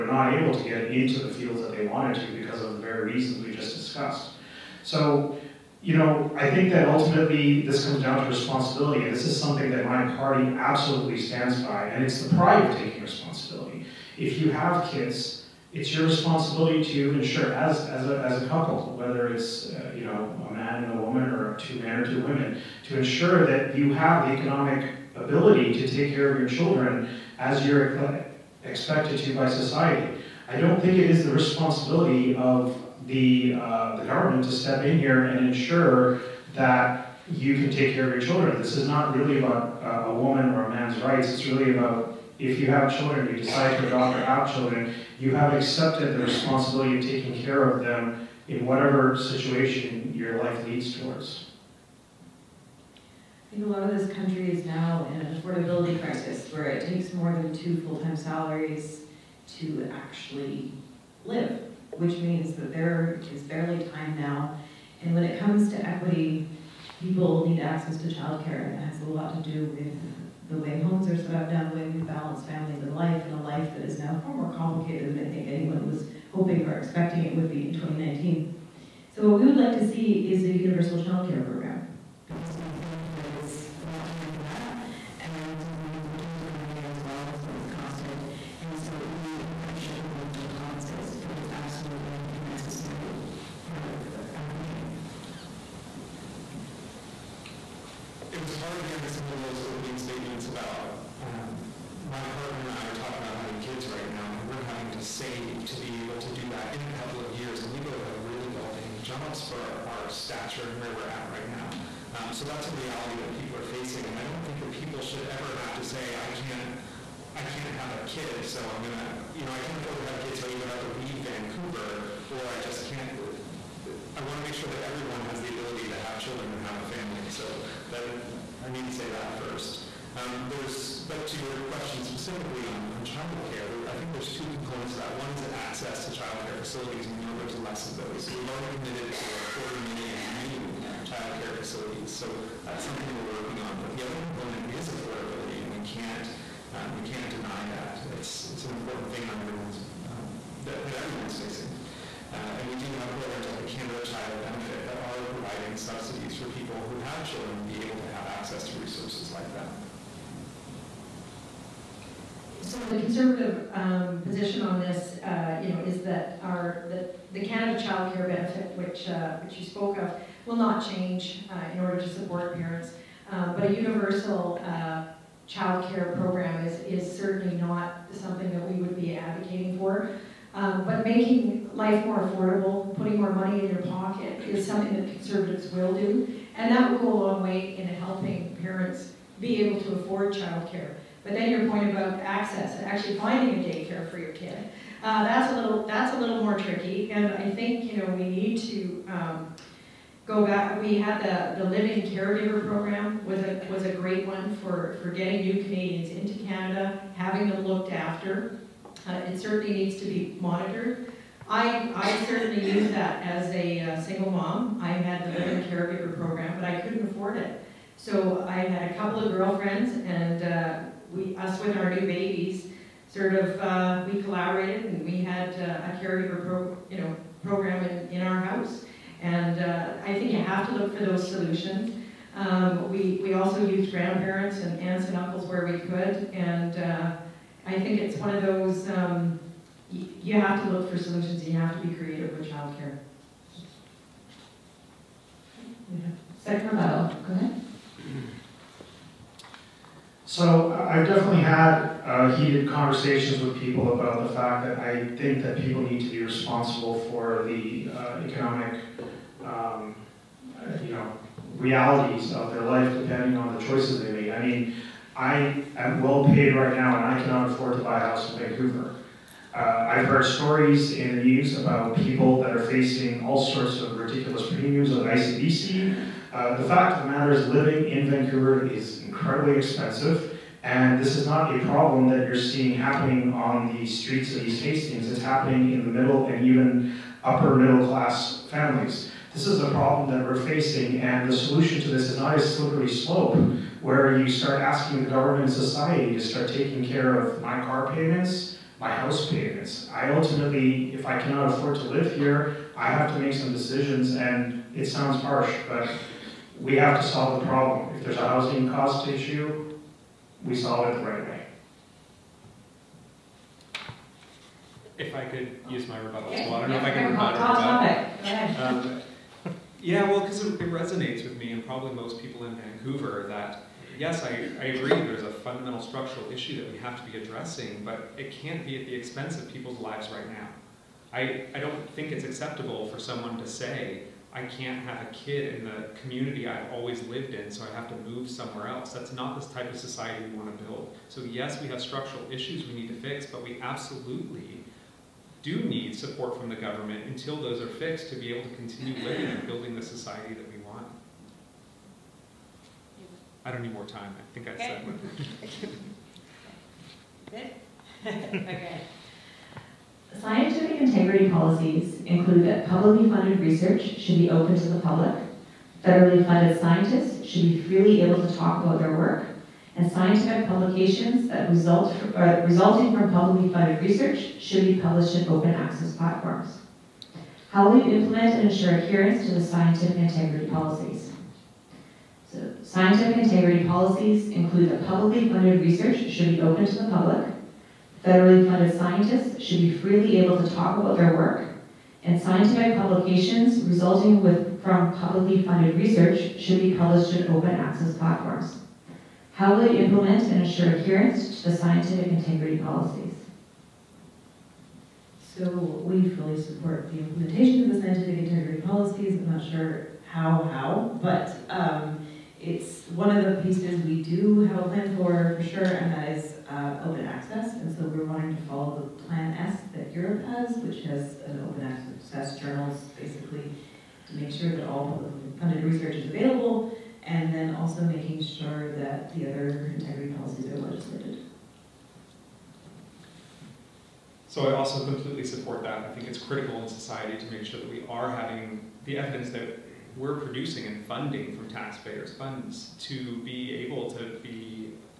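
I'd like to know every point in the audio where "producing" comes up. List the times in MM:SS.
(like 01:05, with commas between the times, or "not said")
07:20.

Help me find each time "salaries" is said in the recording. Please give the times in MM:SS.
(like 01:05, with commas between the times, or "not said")
00:58.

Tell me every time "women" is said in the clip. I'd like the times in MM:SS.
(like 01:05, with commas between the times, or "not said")
00:22.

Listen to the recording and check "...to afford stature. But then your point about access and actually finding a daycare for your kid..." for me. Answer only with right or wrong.
wrong.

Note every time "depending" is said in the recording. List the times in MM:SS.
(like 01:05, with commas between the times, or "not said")
04:22.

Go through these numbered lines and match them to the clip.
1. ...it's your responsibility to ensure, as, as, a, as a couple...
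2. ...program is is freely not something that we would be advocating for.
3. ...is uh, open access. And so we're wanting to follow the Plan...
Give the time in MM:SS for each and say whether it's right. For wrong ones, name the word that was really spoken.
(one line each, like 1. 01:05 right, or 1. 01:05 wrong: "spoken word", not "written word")
1. 00:15 right
2. 02:56 wrong: "certainly", not "freely"
3. 06:56 right.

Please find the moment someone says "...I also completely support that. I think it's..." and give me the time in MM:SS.
07:14.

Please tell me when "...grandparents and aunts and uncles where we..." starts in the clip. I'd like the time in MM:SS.
03:53.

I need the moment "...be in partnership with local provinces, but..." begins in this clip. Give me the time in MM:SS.
01:29.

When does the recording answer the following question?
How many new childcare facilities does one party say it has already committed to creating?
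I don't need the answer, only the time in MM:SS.
02:19.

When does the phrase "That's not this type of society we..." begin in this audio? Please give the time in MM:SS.
05:38.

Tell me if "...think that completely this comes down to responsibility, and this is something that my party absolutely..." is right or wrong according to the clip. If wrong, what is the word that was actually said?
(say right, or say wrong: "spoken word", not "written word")
wrong: "ultimately", not "completely".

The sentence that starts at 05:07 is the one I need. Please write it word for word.
If there's a housing cost issue, we solve it the right way.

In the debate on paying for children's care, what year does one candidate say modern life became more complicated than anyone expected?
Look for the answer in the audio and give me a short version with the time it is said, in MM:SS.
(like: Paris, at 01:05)
2019, at 01:17.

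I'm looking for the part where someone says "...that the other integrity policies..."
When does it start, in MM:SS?
07:08.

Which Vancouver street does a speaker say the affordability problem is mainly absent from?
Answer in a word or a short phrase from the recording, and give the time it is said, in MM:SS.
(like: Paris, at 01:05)
East Hastings, at 04:44.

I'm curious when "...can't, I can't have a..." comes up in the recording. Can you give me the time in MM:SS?
01:56.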